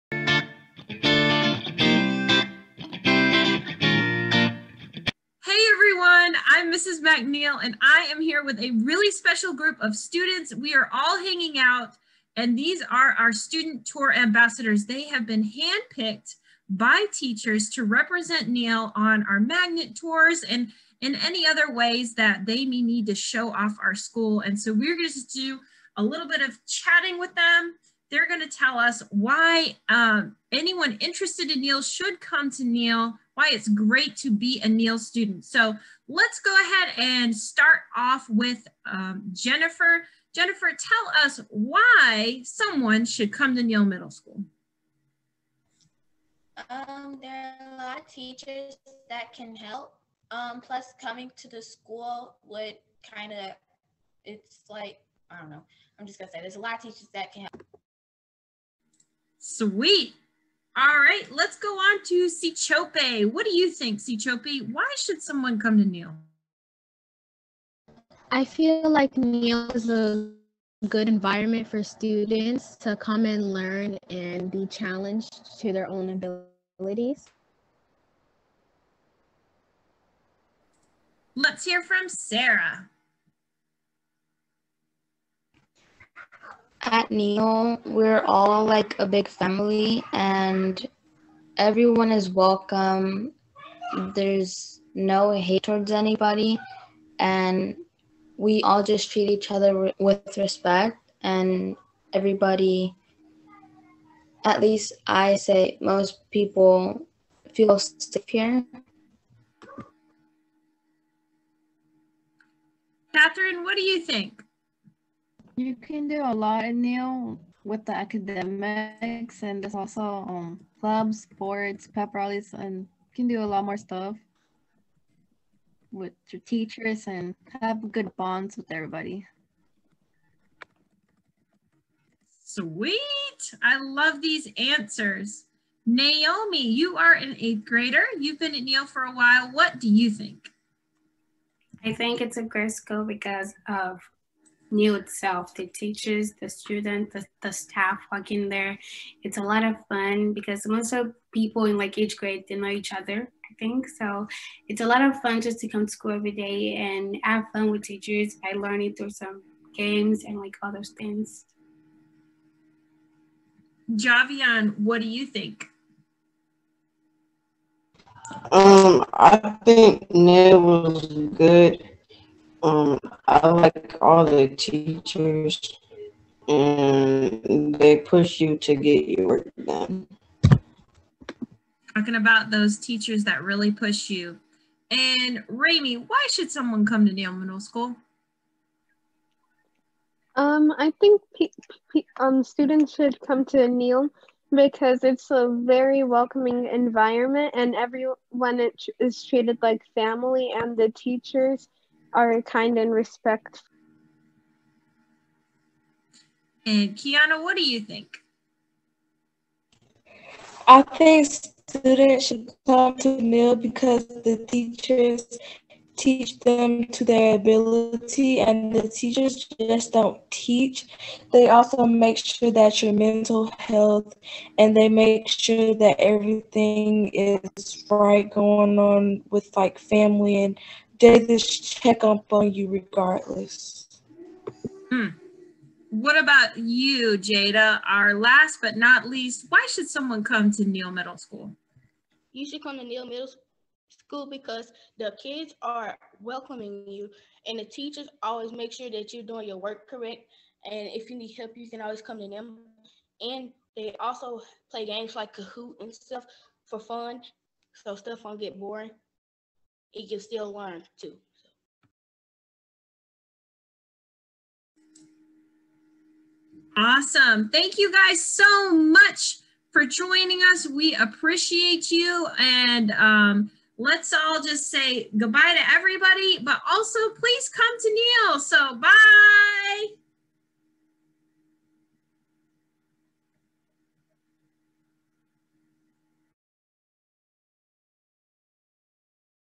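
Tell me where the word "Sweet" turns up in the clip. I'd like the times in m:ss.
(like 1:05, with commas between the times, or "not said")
0:59, 2:12.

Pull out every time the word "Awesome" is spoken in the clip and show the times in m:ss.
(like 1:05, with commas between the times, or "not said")
4:26.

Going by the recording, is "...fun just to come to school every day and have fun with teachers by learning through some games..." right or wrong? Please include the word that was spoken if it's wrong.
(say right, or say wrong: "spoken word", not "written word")
right.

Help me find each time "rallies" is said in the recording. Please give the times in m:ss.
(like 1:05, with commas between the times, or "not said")
2:02.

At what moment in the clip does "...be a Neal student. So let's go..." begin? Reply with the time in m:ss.
0:34.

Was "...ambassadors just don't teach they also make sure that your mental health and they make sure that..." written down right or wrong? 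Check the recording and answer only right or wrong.
wrong.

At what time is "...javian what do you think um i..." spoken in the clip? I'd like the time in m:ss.
2:43.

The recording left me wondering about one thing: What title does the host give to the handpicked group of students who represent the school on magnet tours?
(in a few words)
Student tour ambassadors.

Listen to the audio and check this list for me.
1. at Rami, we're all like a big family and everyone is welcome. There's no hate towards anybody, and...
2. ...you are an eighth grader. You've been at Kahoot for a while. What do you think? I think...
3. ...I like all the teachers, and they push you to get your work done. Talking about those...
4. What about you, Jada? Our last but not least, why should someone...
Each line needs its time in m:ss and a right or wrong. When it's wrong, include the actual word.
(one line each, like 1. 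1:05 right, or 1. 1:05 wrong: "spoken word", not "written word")
1. 1:26 wrong: "Neal", not "Rami"
2. 2:16 wrong: "Neal", not "Kahoot"
3. 2:53 right
4. 3:55 right.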